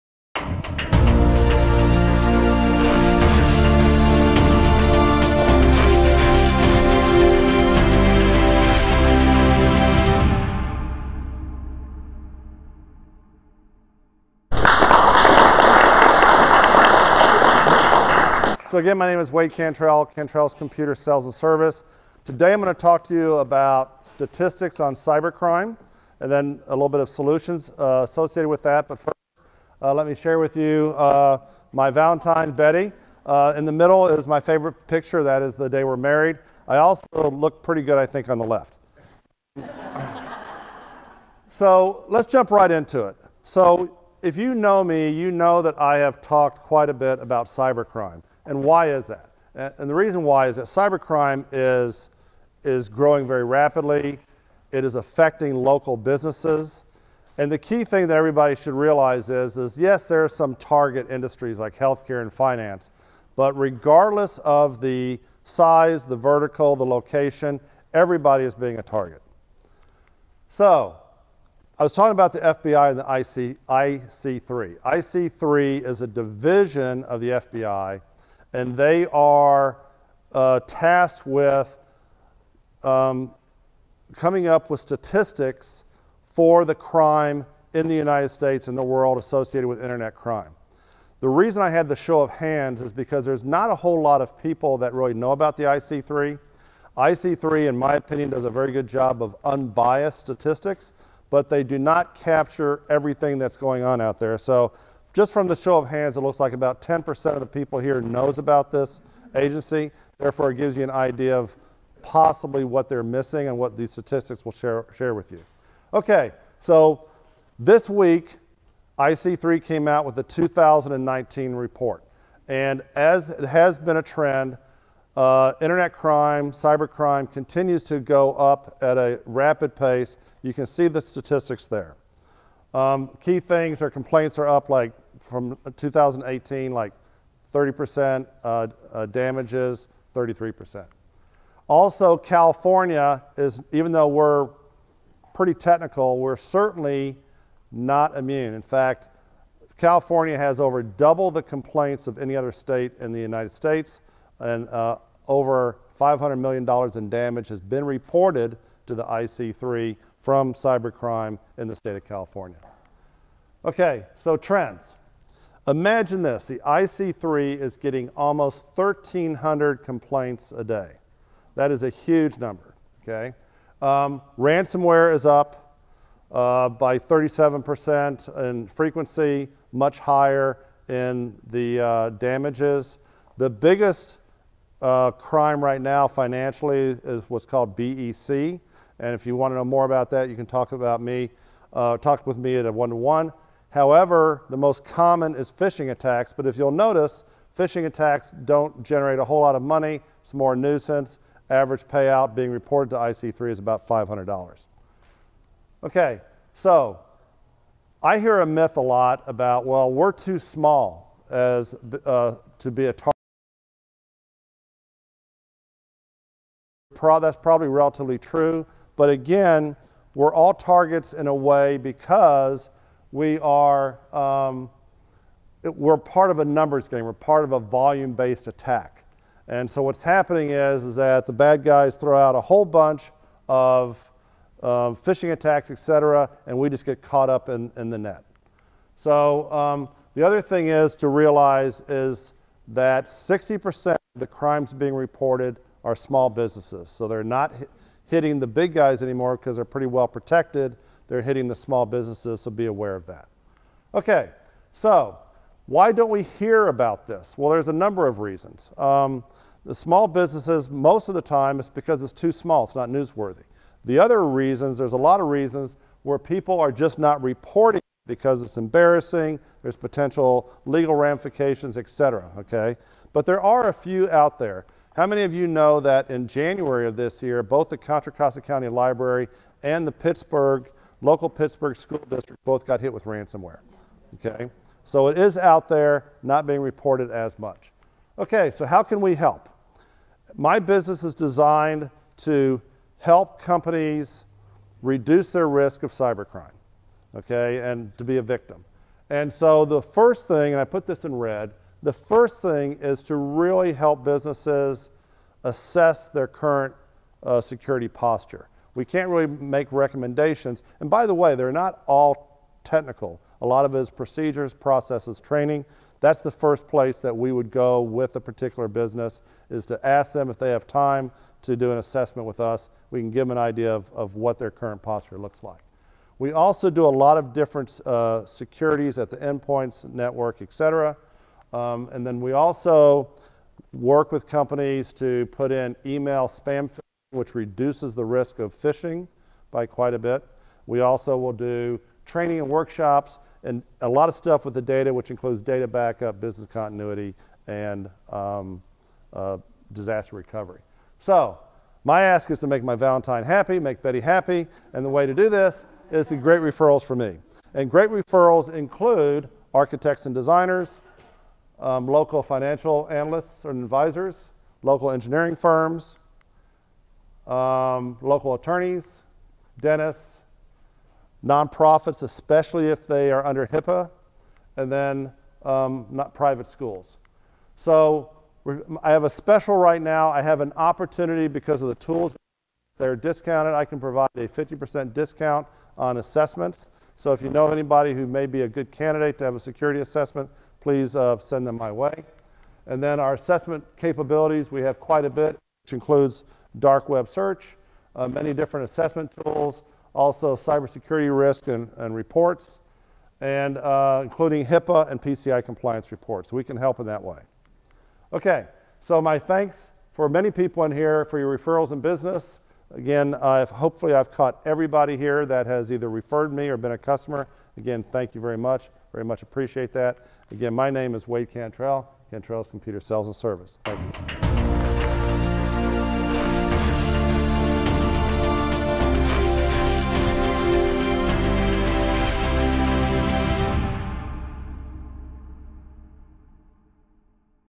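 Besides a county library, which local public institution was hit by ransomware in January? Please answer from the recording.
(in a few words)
Pittsburg school district.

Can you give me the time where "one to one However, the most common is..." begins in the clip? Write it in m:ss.
3:13.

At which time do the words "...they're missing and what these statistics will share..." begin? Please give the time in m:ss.
1:52.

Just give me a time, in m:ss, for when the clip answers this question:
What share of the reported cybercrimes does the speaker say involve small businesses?
4:03.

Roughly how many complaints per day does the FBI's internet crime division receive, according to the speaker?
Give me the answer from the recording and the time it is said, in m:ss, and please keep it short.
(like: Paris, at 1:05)
almost 1,300, at 2:48.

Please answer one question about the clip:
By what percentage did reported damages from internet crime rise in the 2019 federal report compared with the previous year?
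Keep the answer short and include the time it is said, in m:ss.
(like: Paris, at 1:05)
33%, at 2:20.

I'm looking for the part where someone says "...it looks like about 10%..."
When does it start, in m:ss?
1:46.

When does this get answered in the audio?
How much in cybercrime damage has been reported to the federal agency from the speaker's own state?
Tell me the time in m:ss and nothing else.
2:35.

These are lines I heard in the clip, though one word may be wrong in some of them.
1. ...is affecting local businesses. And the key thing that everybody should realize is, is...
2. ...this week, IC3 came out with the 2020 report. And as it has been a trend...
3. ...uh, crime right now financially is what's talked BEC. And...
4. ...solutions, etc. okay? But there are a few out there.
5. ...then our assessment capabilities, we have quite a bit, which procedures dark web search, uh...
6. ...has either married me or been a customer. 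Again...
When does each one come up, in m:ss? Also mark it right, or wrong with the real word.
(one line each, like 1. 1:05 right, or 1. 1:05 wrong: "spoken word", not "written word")
1. 0:54 right
2. 1:57 wrong: "2019", not "2020"
3. 3:04 wrong: "called", not "talked"
4. 4:30 wrong: "ramifications", not "solutions"
5. 6:32 wrong: "includes", not "procedures"
6. 6:55 wrong: "referred", not "married".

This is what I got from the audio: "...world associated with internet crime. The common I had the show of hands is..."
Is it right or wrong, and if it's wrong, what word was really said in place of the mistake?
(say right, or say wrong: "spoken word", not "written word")
wrong: "reason", not "common".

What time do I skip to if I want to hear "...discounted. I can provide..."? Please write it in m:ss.
6:22.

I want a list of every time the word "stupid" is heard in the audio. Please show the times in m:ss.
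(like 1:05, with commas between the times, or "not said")
not said.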